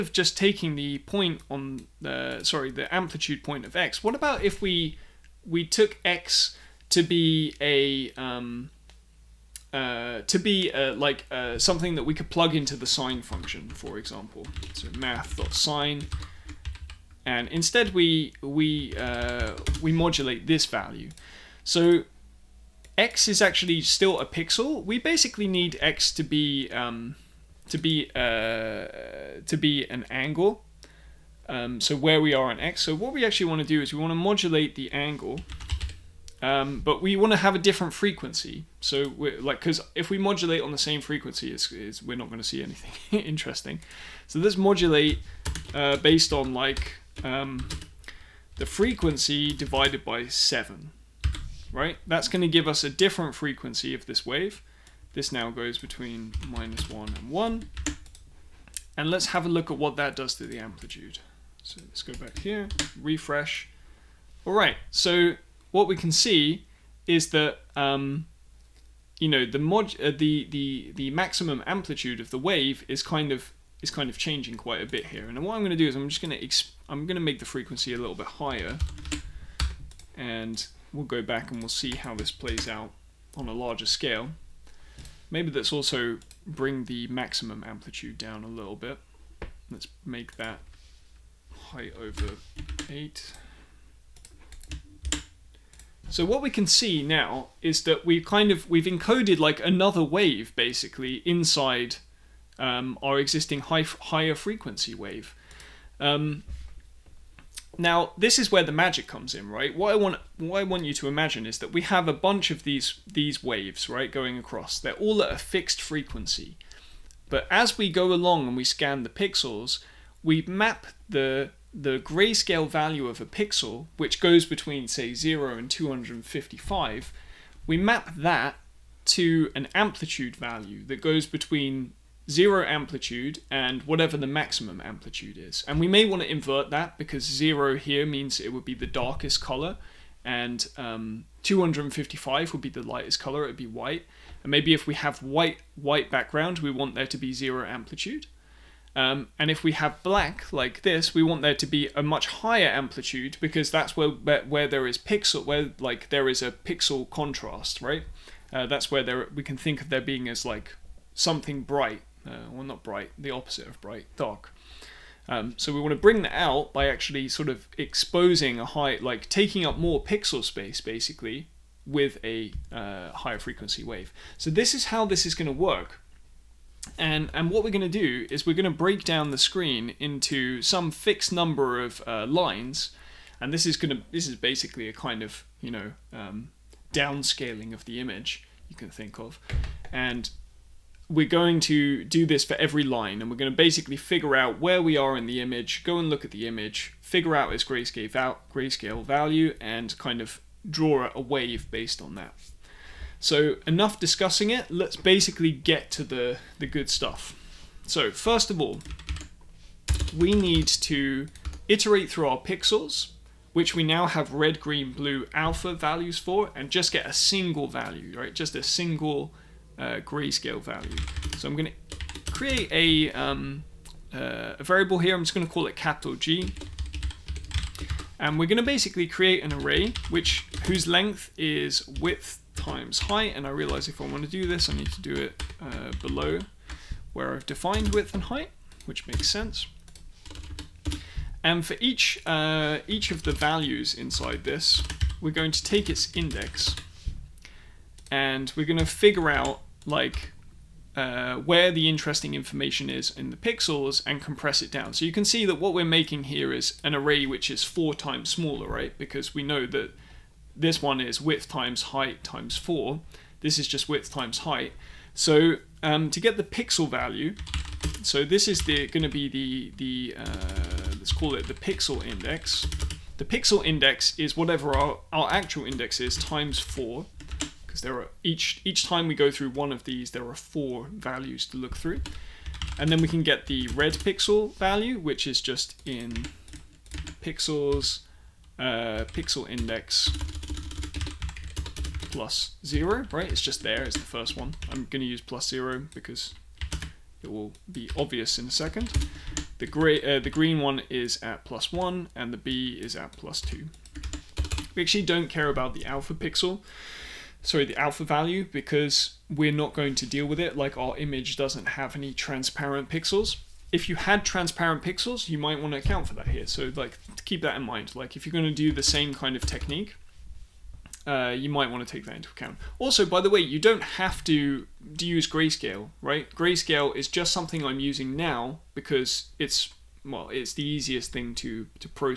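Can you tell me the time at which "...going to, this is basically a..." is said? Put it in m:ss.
3:03.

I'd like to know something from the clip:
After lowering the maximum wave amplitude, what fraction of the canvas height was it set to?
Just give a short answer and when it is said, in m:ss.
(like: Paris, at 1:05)
height over 8, at 1:31.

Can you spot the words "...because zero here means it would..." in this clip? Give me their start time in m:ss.
2:16.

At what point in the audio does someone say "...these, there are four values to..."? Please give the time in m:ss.
4:39.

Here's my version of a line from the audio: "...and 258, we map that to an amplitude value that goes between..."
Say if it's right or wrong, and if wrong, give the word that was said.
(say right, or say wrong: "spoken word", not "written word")
wrong: "255", not "258".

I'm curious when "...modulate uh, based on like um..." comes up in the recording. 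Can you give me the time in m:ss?
0:44.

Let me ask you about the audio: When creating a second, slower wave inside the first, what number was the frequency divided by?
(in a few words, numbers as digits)
7.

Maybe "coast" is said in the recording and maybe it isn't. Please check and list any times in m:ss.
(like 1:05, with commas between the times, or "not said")
not said.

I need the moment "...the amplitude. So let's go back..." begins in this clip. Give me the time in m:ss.
1:00.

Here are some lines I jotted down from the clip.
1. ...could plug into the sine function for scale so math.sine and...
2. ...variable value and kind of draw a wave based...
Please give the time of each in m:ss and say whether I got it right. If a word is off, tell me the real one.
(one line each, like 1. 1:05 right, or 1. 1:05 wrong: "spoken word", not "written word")
1. 0:12 wrong: "example", not "scale"
2. 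3:18 wrong: "grayscale", not "variable".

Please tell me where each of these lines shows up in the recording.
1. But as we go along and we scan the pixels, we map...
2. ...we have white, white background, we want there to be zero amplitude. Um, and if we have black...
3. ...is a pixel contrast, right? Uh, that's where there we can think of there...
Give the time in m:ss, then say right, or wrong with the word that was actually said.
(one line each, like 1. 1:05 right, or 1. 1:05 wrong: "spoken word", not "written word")
1. 1:57 right
2. 2:24 right
3. 2:36 right.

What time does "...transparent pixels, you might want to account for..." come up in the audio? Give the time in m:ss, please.
5:14.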